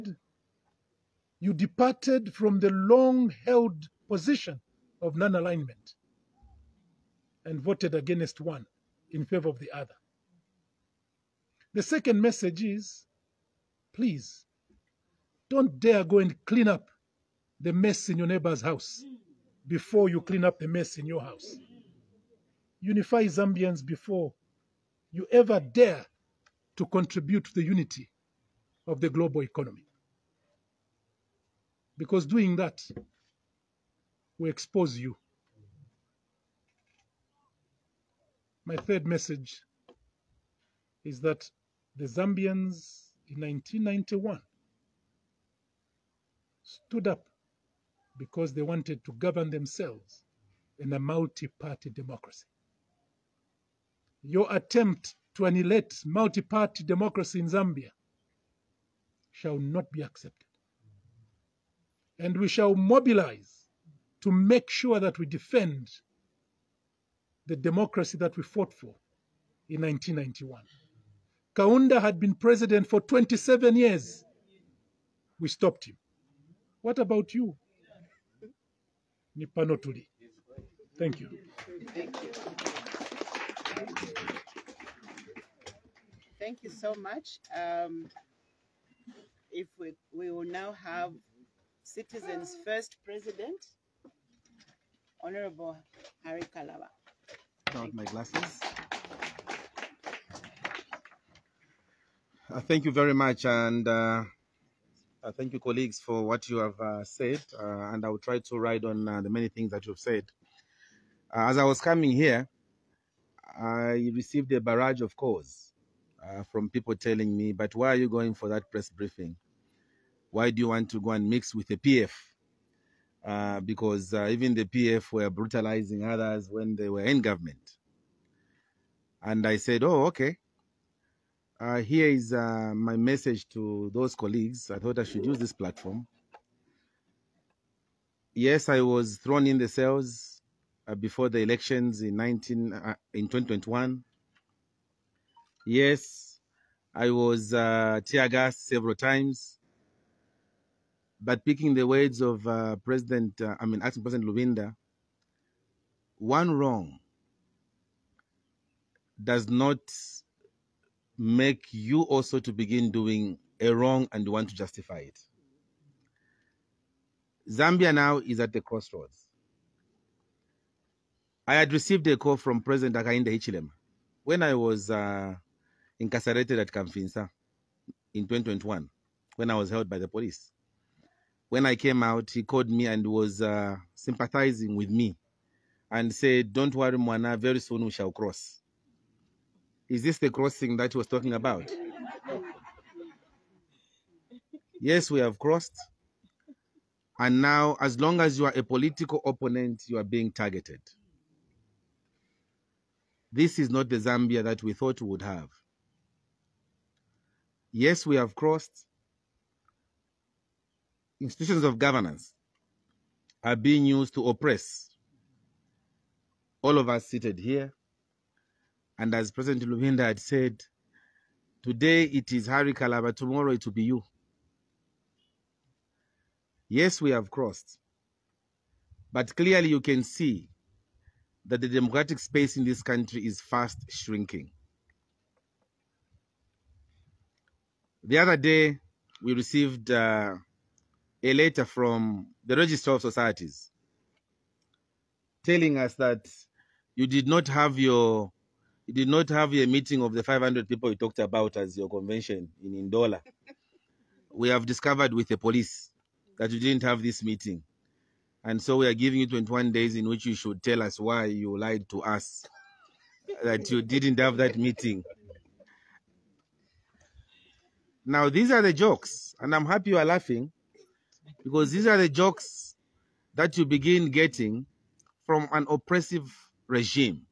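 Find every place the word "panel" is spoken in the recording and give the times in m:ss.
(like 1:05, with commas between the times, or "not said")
not said.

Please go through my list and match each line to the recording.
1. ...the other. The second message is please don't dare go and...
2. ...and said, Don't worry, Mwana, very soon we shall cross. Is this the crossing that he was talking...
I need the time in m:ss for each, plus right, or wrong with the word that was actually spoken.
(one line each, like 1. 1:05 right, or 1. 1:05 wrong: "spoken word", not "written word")
1. 0:09 right
2. 3:05 right.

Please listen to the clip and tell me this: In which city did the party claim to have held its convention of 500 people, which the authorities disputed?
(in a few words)
Ndola.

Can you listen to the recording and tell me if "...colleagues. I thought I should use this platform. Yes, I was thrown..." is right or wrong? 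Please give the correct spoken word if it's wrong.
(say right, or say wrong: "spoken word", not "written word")
right.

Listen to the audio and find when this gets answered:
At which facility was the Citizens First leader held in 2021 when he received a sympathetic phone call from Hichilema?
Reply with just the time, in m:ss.
2:56.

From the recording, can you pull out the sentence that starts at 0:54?
Your attempt to annihilate multi party democracy in Zambia shall not be accepted.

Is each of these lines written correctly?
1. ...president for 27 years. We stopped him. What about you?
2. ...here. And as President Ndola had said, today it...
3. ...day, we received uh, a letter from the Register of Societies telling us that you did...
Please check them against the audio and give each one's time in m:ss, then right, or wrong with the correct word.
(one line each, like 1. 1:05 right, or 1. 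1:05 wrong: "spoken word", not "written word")
1. 1:12 right
2. 3:37 wrong: "Lubinda", not "Ndola"
3. 3:58 right.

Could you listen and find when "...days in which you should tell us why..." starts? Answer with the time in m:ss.
4:19.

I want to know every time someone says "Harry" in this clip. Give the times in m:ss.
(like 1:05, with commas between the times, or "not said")
1:36, 3:42.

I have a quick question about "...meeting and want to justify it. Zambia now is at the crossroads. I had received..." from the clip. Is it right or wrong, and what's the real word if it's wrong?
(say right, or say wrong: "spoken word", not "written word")
wrong: "wrong", not "meeting".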